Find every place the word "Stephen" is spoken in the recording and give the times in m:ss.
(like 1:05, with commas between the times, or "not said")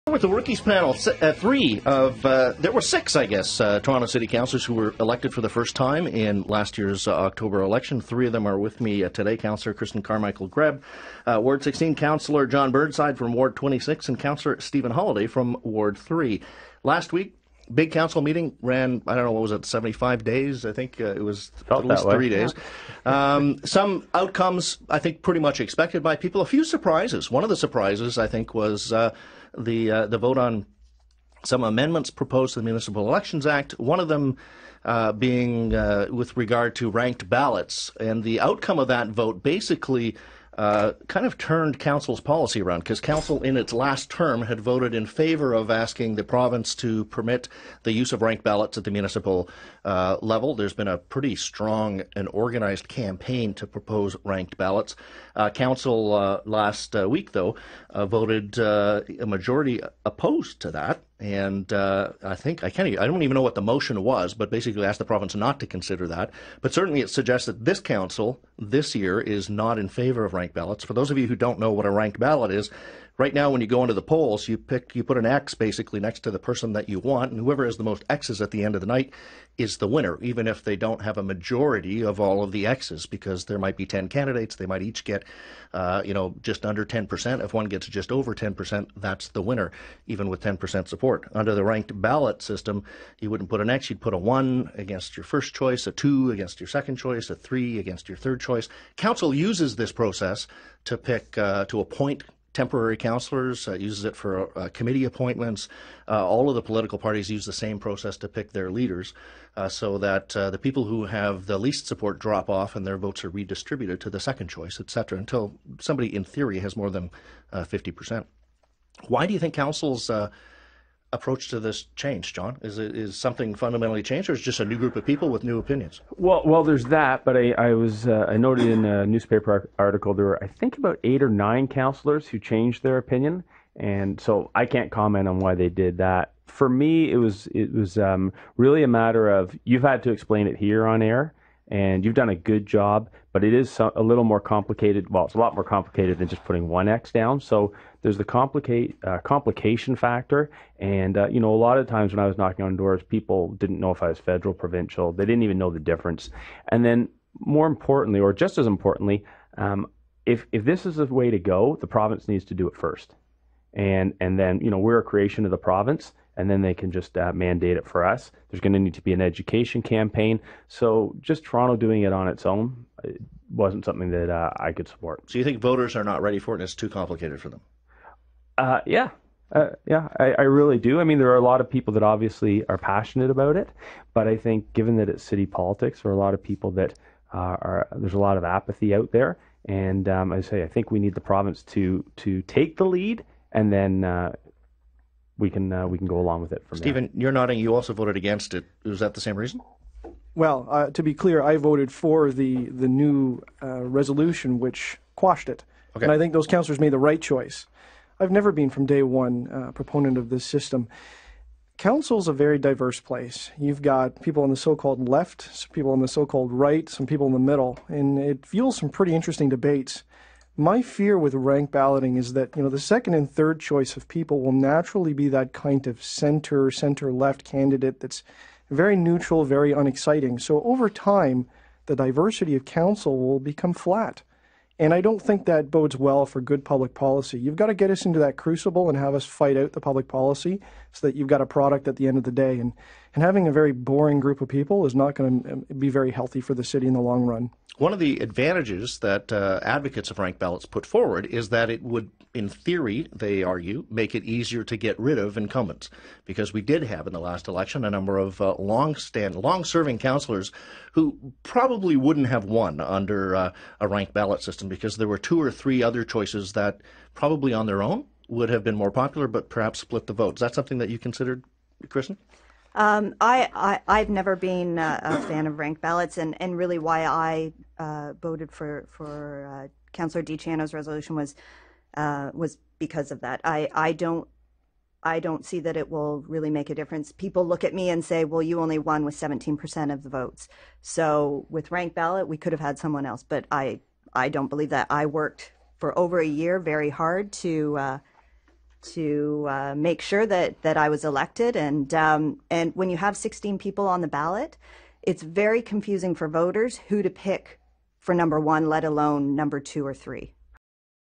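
0:14, 3:16.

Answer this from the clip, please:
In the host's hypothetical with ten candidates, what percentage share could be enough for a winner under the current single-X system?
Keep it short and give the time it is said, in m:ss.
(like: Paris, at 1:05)
10%, at 1:27.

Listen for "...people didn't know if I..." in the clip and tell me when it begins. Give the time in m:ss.
2:33.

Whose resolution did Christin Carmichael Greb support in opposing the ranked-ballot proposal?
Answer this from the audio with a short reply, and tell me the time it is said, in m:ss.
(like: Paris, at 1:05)
Councillor Di Ciano, at 4:39.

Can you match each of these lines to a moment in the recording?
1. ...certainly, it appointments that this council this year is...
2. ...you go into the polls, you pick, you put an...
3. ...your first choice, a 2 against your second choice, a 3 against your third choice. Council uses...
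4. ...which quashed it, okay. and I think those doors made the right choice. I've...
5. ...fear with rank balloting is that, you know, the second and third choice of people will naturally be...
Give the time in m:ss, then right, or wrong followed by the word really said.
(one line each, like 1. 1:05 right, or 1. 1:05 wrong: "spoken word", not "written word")
1. 1:06 wrong: "suggests", not "appointments"
2. 1:13 right
3. 1:35 right
4. 3:24 wrong: "councillors", not "doors"
5. 3:40 right.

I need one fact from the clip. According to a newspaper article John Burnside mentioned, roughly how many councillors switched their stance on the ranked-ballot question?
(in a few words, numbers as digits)
eight or nine.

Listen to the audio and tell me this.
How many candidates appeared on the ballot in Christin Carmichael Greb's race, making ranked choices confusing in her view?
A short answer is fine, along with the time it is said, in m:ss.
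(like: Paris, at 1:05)
16, at 5:03.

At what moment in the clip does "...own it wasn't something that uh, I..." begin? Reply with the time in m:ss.
2:52.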